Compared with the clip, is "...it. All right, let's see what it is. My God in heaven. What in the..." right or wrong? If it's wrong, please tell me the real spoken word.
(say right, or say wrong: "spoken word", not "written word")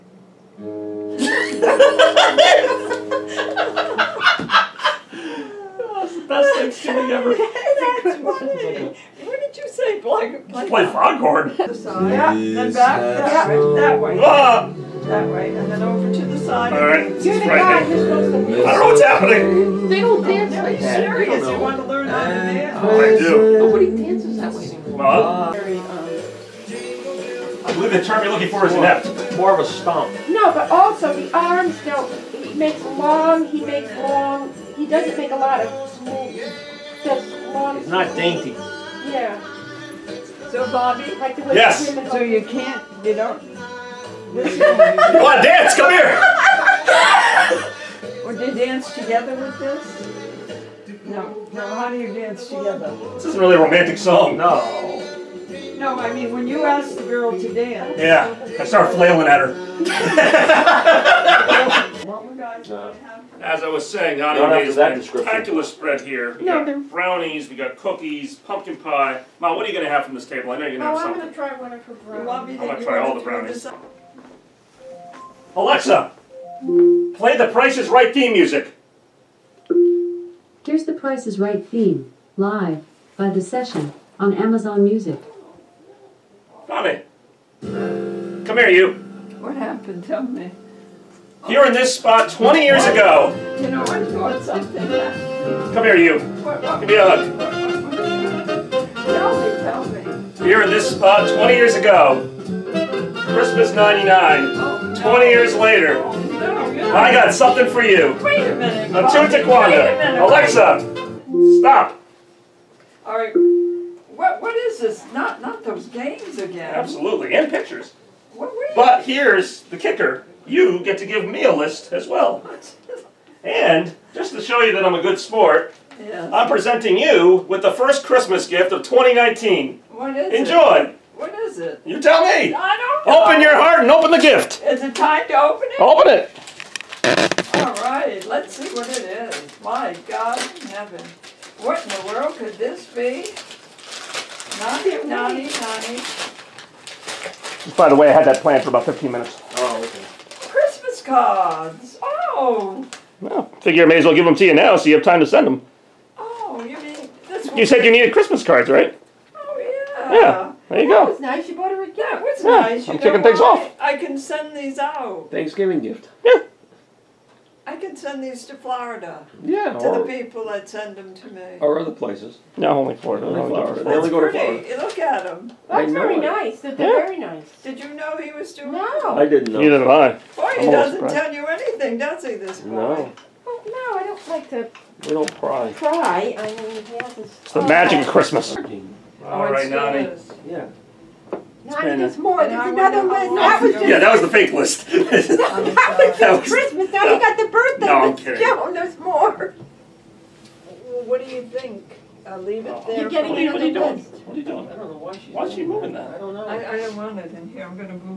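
right.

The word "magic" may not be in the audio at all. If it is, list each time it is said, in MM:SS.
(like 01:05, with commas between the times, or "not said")
03:07.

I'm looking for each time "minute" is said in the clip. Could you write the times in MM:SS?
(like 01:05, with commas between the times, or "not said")
01:48, 02:29.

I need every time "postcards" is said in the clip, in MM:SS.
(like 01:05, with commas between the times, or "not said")
02:31.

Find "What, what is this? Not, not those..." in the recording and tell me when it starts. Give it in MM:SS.
01:54.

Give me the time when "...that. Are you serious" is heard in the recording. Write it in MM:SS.
00:20.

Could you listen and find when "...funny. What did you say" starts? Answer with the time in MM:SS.
00:08.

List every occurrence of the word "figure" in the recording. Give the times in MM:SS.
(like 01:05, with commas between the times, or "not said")
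02:33.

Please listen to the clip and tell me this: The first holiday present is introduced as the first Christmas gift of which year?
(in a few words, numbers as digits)
2019.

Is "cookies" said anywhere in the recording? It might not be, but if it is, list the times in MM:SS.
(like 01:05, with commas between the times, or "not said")
01:07.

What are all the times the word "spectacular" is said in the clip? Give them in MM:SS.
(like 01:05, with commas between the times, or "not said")
01:05.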